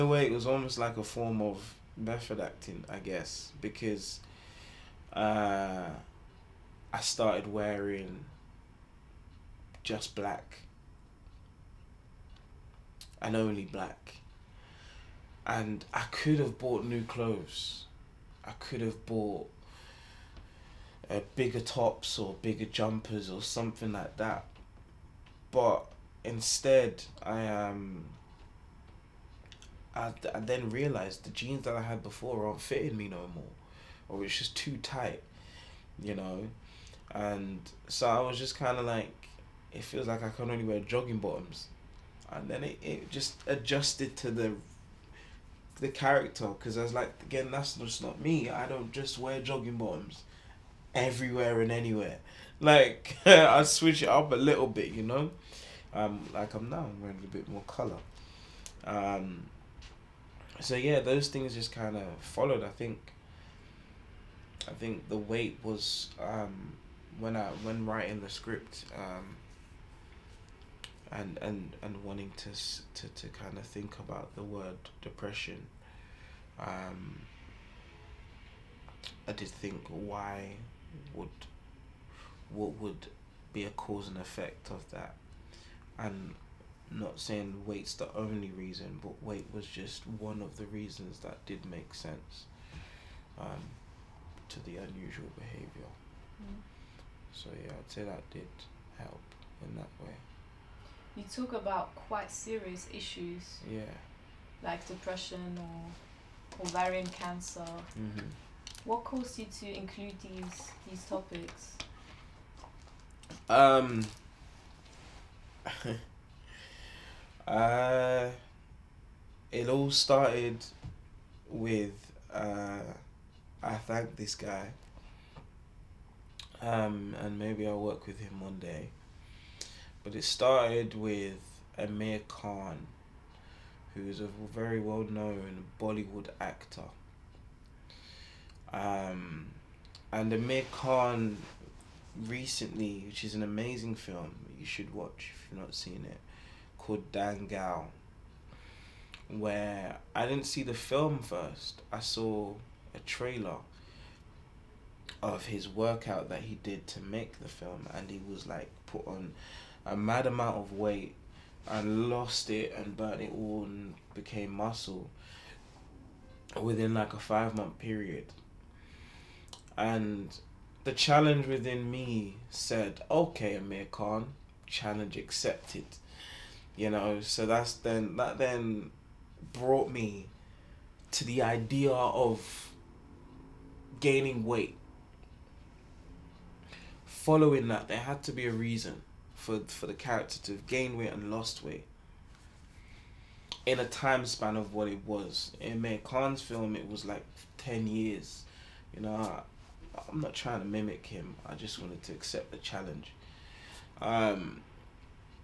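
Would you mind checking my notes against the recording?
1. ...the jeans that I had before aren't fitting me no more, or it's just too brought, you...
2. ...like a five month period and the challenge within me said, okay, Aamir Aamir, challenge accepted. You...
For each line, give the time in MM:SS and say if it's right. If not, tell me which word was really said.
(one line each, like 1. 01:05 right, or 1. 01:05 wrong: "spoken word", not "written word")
1. 00:31 wrong: "tight", not "brought"
2. 02:46 wrong: "Khan", not "Aamir".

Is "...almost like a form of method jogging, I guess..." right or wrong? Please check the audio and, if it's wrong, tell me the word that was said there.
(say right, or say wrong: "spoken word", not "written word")
wrong: "acting", not "jogging".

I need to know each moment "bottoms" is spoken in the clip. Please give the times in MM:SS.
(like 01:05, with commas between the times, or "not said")
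00:41, 00:49.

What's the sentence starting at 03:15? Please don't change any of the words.
In Aamir Khan's film, it was like 10 years.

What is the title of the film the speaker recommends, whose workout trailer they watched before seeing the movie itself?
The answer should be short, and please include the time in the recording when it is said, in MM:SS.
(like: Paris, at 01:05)
Dangal, at 02:27.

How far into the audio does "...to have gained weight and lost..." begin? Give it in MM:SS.
03:10.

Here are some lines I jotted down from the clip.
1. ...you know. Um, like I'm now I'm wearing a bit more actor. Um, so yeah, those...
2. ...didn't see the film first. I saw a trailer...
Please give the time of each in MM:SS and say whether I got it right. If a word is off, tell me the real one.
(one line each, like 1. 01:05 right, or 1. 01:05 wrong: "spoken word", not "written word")
1. 00:54 wrong: "color", not "actor"
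2. 02:30 right.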